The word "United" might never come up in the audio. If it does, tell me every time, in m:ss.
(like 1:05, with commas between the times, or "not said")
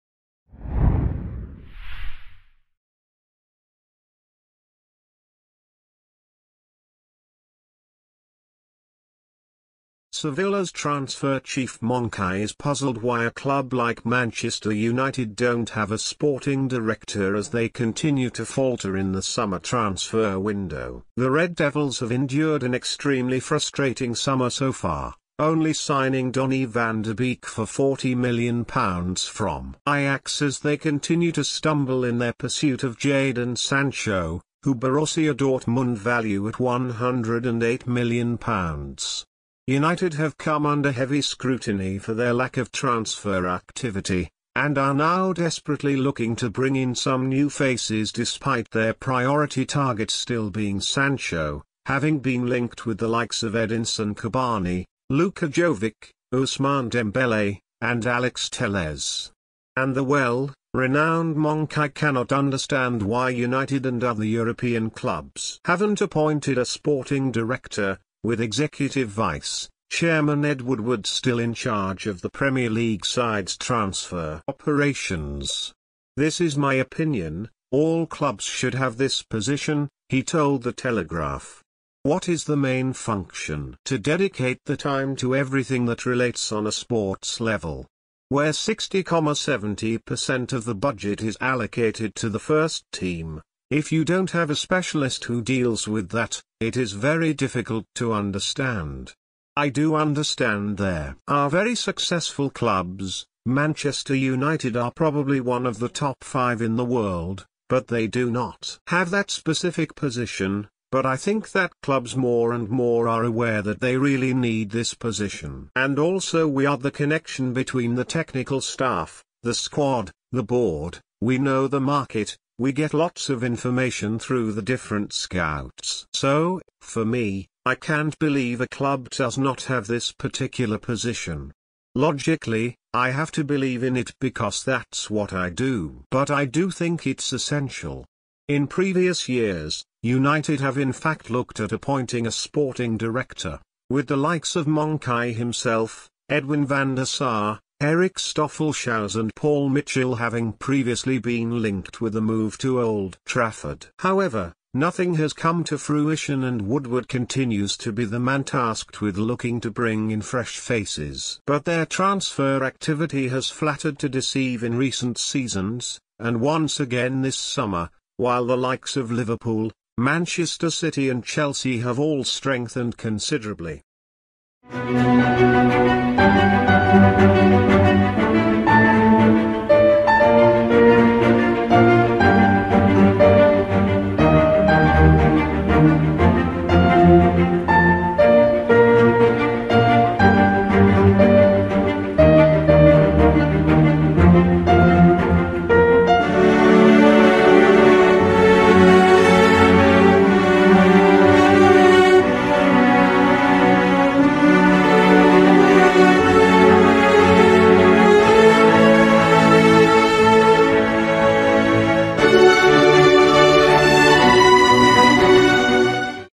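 0:14, 0:39, 1:03, 1:44, 2:20.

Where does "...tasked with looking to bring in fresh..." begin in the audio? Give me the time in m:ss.
2:38.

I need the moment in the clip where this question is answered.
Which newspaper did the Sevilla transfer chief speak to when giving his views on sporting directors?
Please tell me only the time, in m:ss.
1:20.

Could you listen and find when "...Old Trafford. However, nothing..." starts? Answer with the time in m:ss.
2:32.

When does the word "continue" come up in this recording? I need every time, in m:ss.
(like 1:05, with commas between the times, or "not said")
0:17, 0:30, 2:37.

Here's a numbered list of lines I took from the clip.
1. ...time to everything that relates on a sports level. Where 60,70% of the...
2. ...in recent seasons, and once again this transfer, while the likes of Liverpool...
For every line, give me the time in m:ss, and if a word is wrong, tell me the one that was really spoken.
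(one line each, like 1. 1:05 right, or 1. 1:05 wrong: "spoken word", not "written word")
1. 1:24 right
2. 2:44 wrong: "summer", not "transfer".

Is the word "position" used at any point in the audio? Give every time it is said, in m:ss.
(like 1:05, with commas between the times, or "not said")
1:19, 1:49, 1:54, 2:10.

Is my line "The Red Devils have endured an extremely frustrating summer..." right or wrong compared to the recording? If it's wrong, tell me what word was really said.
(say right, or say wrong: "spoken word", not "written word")
right.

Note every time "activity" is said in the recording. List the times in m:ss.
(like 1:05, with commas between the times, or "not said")
0:43, 2:42.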